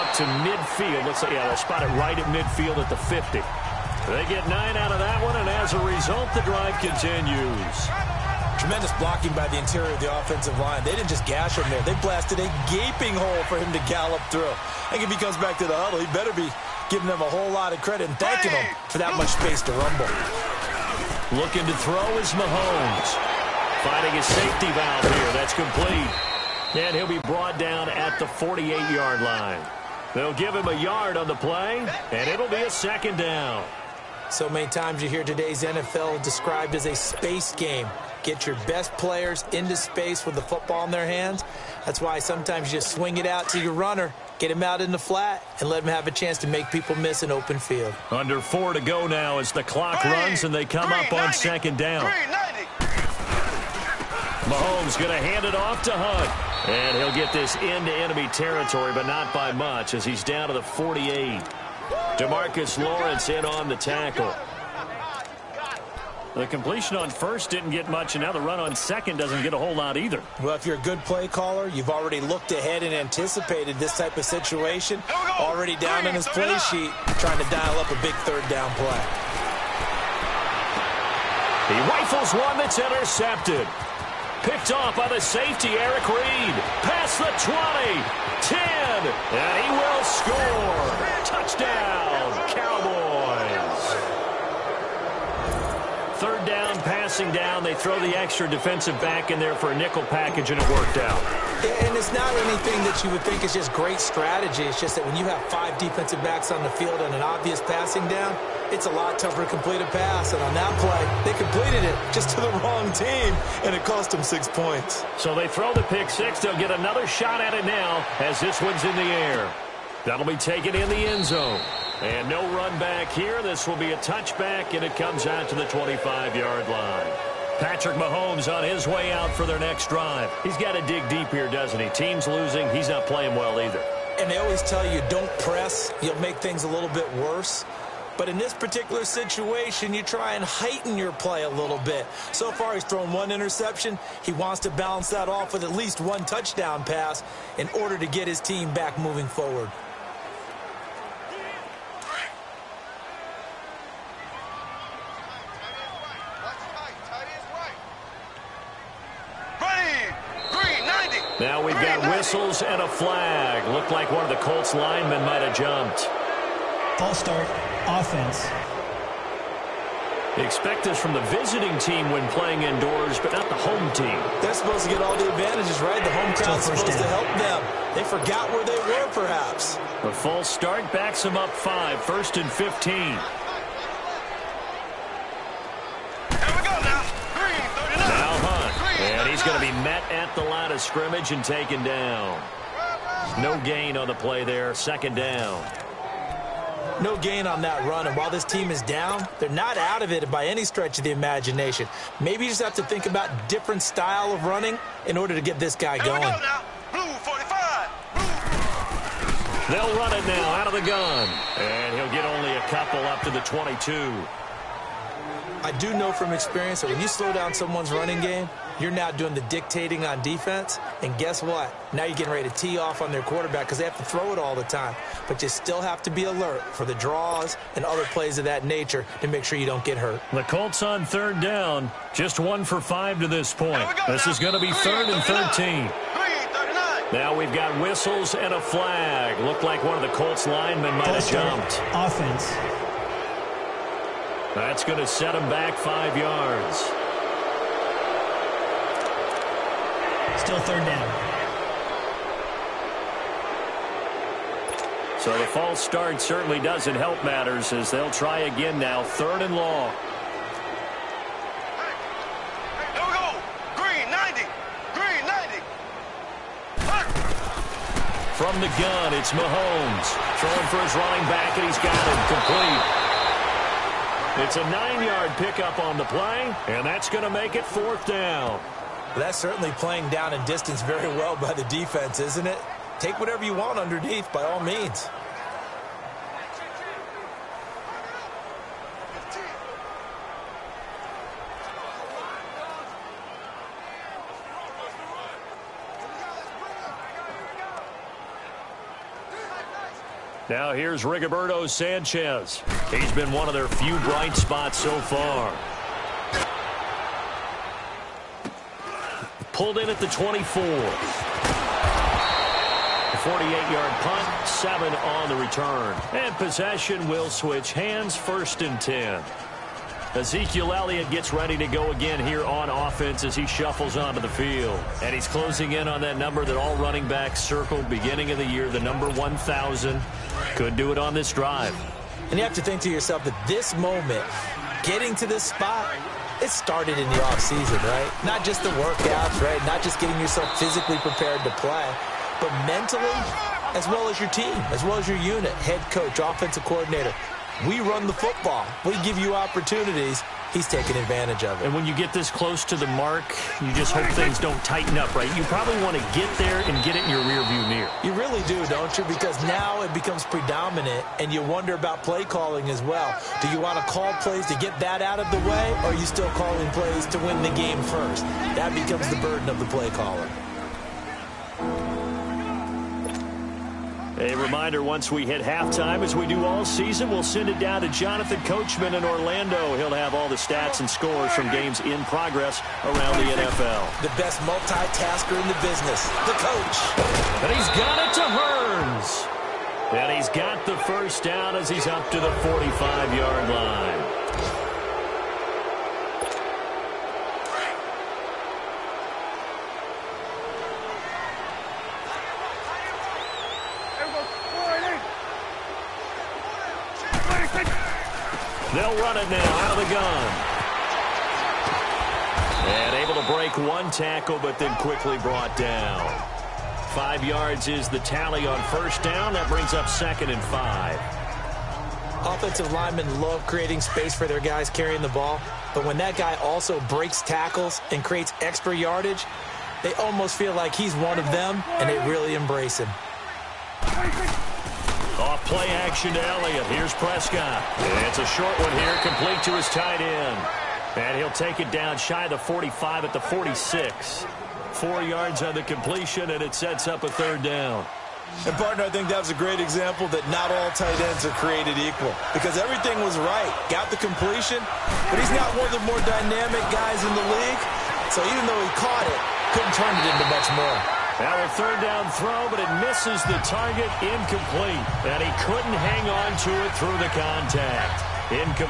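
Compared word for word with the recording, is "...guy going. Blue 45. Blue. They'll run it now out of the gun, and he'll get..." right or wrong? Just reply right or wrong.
right.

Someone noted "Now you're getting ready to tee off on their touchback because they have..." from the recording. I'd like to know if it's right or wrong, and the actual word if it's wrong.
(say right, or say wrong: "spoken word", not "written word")
wrong: "quarterback", not "touchback".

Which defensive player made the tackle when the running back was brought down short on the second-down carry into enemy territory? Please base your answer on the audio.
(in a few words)
DeMarcus Lawrence.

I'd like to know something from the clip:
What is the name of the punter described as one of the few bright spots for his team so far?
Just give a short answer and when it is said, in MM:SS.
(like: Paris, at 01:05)
Rigoberto Sanchez, at 05:01.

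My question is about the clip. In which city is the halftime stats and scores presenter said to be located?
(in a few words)
Orlando.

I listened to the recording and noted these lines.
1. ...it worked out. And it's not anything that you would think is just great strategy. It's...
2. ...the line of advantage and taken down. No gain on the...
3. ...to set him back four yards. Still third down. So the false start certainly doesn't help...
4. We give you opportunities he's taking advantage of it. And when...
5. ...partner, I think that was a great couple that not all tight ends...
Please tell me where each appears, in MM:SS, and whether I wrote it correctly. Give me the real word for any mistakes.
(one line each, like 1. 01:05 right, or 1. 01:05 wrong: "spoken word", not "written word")
1. 01:40 right
2. 03:10 wrong: "scrimmage", not "advantage"
3. 04:04 wrong: "five", not "four"
4. 05:48 right
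5. 07:28 wrong: "example", not "couple".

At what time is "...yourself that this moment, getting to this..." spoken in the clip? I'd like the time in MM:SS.
05:32.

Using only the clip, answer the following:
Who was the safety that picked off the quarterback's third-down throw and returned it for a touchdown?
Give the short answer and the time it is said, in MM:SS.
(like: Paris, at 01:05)
Eric Reid, at 01:25.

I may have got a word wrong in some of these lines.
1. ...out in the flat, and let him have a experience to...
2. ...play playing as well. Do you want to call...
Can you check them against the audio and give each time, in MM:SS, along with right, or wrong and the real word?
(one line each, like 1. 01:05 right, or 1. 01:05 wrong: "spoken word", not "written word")
1. 00:44 wrong: "chance", not "experience"
2. 06:02 wrong: "calling", not "playing".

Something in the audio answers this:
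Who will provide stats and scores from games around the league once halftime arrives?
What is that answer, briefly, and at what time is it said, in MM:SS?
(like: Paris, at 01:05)
Jonathan Coachman, at 06:17.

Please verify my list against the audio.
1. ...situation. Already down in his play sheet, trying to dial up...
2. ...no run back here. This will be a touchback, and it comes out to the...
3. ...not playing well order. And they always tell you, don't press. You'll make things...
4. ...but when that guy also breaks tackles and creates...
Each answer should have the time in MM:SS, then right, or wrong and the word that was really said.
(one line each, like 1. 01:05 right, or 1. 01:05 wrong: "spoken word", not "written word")
1. 01:14 right
2. 02:02 right
3. 02:12 wrong: "either", not "order"
4. 07:05 right.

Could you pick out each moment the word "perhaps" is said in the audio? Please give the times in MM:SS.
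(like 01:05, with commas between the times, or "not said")
02:59.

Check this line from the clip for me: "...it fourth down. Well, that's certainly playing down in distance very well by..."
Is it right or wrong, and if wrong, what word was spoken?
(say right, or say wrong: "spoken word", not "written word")
right.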